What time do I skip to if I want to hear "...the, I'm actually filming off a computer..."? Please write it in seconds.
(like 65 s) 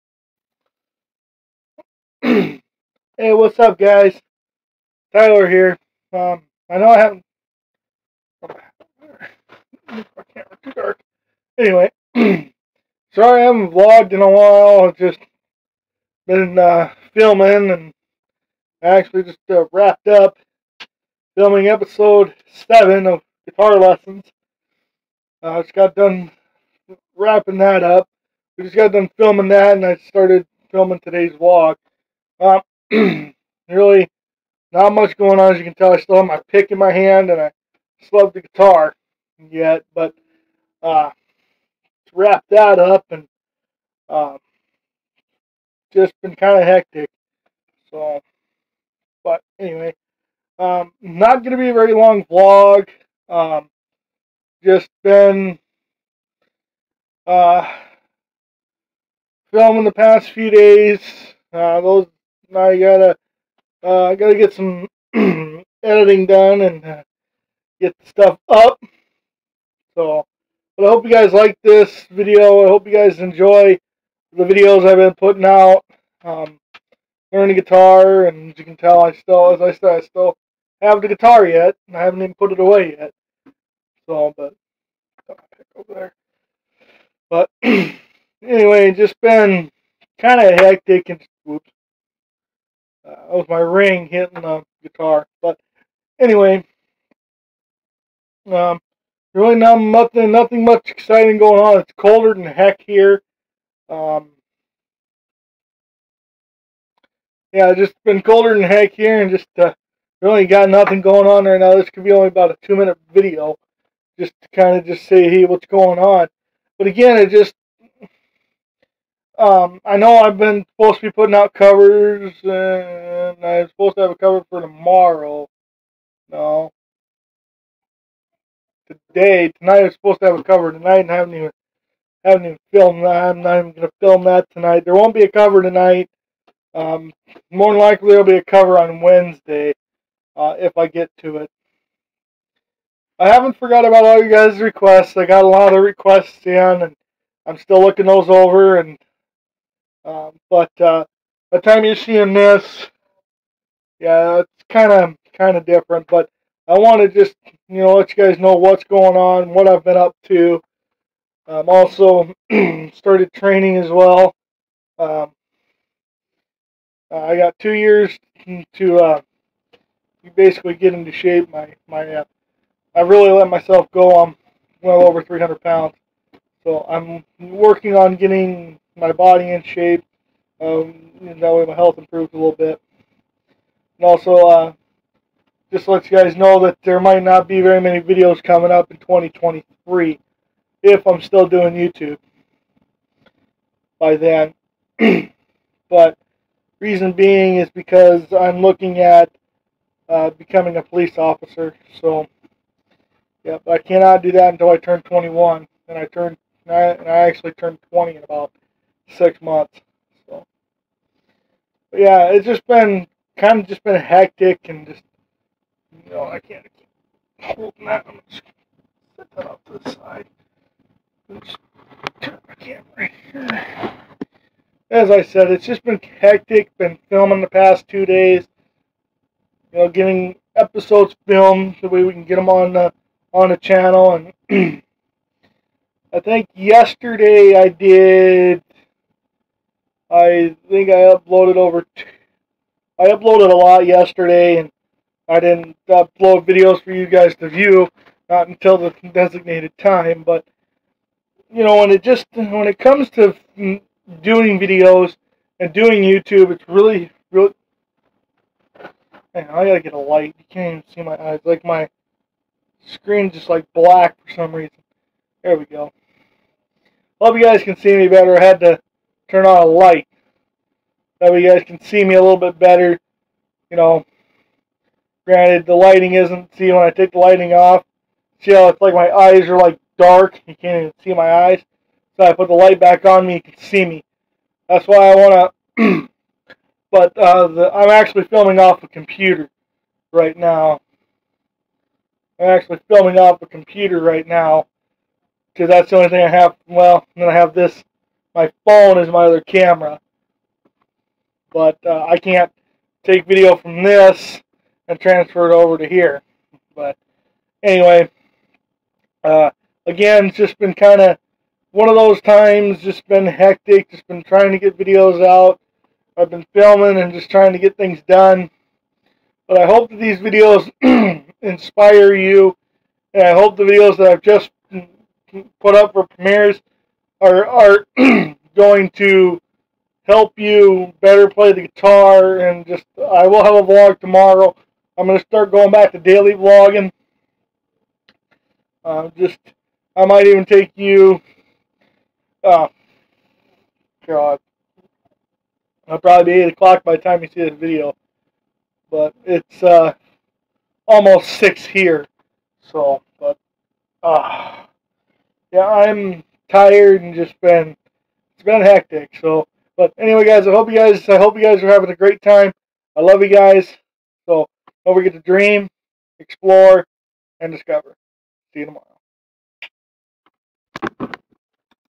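287 s.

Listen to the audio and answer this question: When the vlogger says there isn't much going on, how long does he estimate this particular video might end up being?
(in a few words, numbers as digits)
2 minutes.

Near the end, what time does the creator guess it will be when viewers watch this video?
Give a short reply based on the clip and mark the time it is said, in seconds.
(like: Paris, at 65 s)
8 o'clock, at 346 s.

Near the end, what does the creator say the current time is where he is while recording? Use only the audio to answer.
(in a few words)
Almost 6.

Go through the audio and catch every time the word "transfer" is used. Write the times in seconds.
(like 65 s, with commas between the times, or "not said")
304 s.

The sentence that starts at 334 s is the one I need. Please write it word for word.
I'm gonna start going back to daily vlogging.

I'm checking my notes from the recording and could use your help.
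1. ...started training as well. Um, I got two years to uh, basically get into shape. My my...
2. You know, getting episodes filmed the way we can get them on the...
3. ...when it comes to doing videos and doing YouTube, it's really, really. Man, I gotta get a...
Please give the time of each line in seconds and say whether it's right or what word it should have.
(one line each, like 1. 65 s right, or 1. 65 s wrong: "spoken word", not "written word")
1. 162 s right
2. 229 s right
3. 252 s right.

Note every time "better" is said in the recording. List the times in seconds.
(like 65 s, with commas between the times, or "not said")
268 s, 272 s, 330 s.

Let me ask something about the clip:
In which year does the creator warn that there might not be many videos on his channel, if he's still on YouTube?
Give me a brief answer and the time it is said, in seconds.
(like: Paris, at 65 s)
2023, at 188 s.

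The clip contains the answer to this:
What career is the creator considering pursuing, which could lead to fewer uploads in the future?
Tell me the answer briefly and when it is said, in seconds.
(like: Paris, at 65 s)
Police officer, at 200 s.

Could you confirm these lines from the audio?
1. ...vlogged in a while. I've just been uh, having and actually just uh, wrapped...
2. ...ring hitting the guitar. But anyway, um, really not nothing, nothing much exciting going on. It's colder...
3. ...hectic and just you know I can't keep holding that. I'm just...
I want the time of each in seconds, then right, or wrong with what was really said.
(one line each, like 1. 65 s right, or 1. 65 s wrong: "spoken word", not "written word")
1. 13 s wrong: "filming", not "having"
2. 93 s right
3. 213 s right.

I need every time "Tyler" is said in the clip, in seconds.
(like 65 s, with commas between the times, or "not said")
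5 s.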